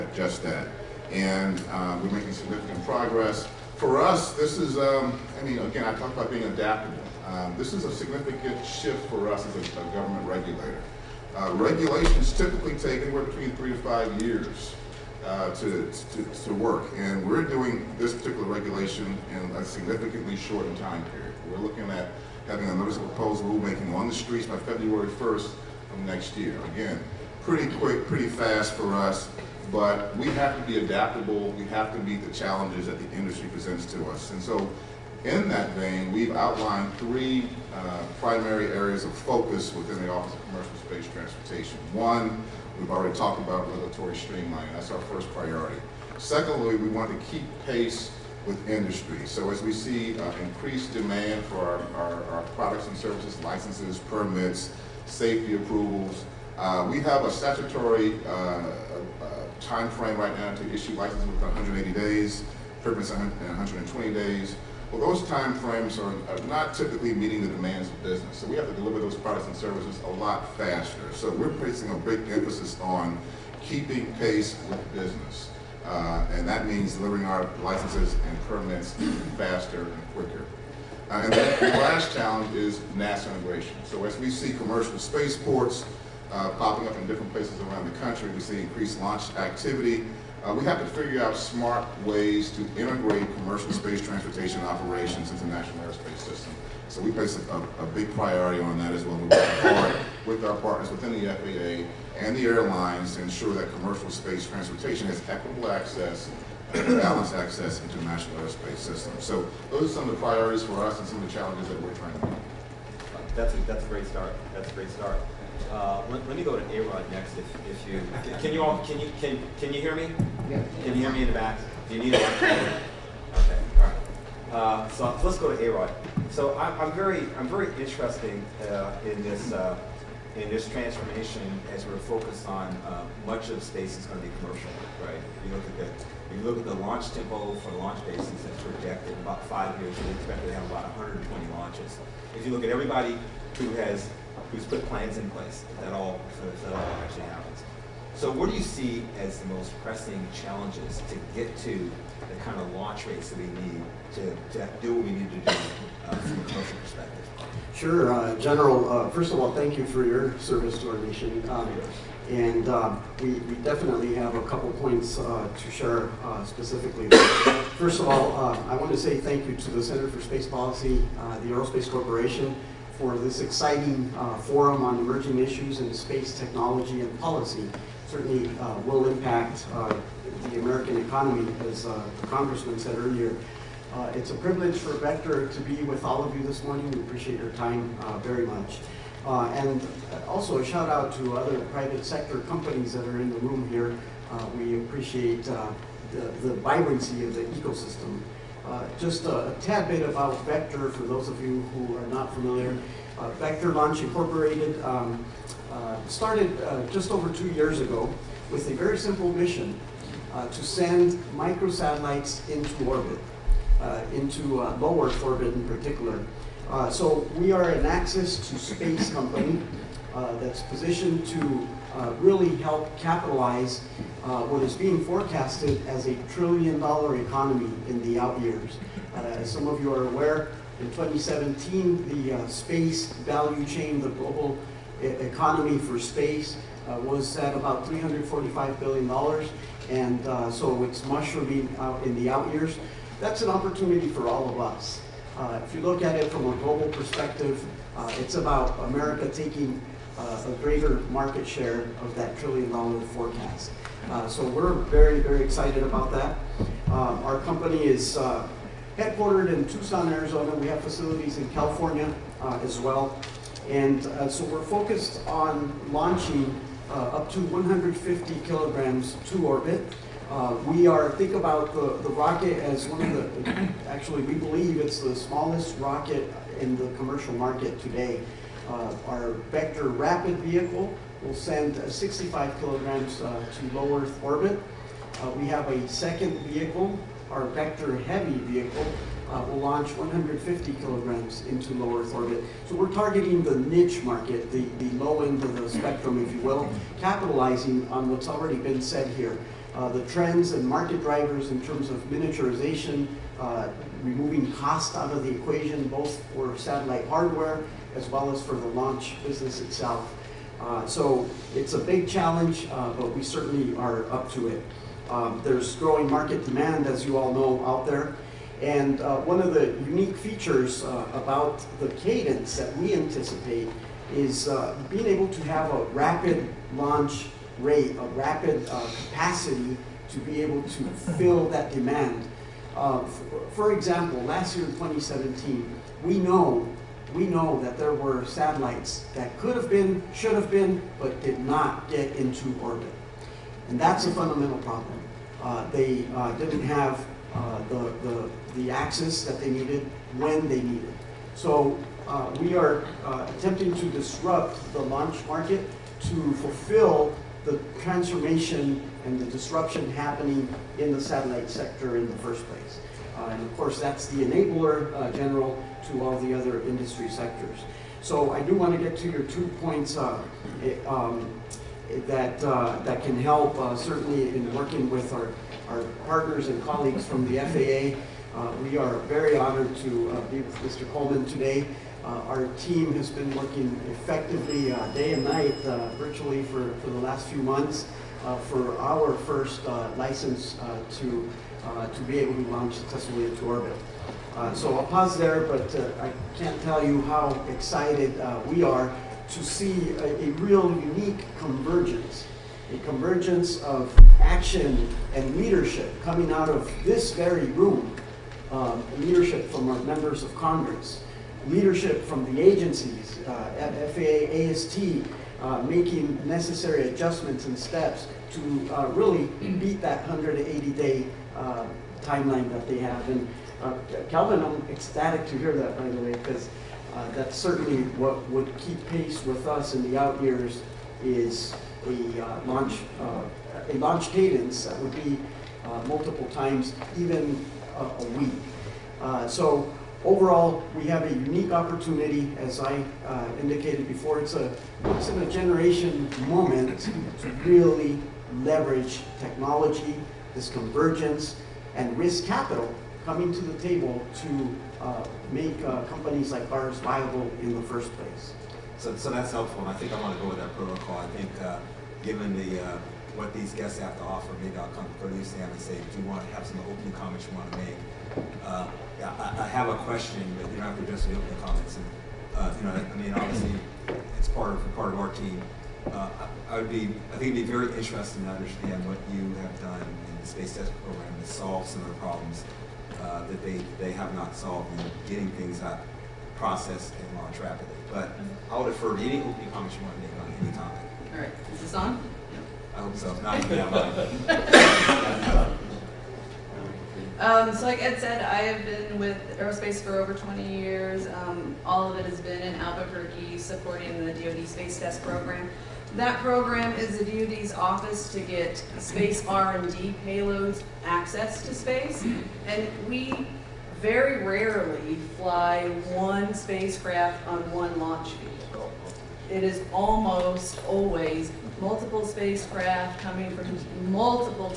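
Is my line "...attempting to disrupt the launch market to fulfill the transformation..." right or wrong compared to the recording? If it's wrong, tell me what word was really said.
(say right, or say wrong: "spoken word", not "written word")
right.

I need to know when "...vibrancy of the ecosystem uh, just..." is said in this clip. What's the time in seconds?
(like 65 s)
196 s.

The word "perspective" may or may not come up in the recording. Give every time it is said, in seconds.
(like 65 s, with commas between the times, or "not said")
156 s, 246 s.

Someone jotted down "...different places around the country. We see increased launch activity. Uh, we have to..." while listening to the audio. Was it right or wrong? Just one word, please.
right.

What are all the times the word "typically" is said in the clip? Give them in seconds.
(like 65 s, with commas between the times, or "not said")
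12 s, 66 s.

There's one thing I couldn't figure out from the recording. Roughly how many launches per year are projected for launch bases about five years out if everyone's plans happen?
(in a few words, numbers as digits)
120.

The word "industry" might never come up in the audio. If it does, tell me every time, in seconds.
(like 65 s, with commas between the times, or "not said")
33 s, 48 s, 366 s.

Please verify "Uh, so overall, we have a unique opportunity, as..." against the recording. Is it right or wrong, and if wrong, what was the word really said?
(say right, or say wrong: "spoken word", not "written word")
right.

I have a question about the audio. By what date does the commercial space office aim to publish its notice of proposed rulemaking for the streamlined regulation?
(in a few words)
February 1st.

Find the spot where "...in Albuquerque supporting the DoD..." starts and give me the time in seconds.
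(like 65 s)
502 s.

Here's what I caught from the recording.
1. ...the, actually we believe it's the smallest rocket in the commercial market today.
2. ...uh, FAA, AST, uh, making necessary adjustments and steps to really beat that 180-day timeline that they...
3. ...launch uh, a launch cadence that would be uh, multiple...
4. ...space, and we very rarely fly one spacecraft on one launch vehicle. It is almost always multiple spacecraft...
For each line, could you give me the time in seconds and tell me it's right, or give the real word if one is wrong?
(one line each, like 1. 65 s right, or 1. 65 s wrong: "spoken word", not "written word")
1. 273 s right
2. 413 s right
3. 432 s right
4. 511 s right.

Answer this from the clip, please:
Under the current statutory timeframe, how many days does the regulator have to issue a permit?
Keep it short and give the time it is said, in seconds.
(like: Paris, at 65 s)
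120 days, at 63 s.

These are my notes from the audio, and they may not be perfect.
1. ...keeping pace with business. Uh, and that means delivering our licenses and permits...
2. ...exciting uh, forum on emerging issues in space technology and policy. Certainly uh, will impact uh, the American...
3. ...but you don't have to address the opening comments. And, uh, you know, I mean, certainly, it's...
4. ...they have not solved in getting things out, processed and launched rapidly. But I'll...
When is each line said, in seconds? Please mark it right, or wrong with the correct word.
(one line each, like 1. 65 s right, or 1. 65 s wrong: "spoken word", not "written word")
1. 73 s right
2. 173 s right
3. 470 s wrong: "obviously", not "certainly"
4. 483 s right.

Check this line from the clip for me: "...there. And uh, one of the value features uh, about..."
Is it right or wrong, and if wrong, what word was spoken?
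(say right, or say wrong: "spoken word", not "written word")
wrong: "unique", not "value".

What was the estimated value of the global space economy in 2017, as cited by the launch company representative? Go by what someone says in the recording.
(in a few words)
$345 billion.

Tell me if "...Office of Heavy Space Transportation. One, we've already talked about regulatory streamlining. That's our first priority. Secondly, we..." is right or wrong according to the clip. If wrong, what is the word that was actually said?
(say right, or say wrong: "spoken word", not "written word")
wrong: "Commercial", not "Heavy".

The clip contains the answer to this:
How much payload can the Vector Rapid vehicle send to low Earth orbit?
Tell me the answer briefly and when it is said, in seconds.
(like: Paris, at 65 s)
65 kilograms, at 281 s.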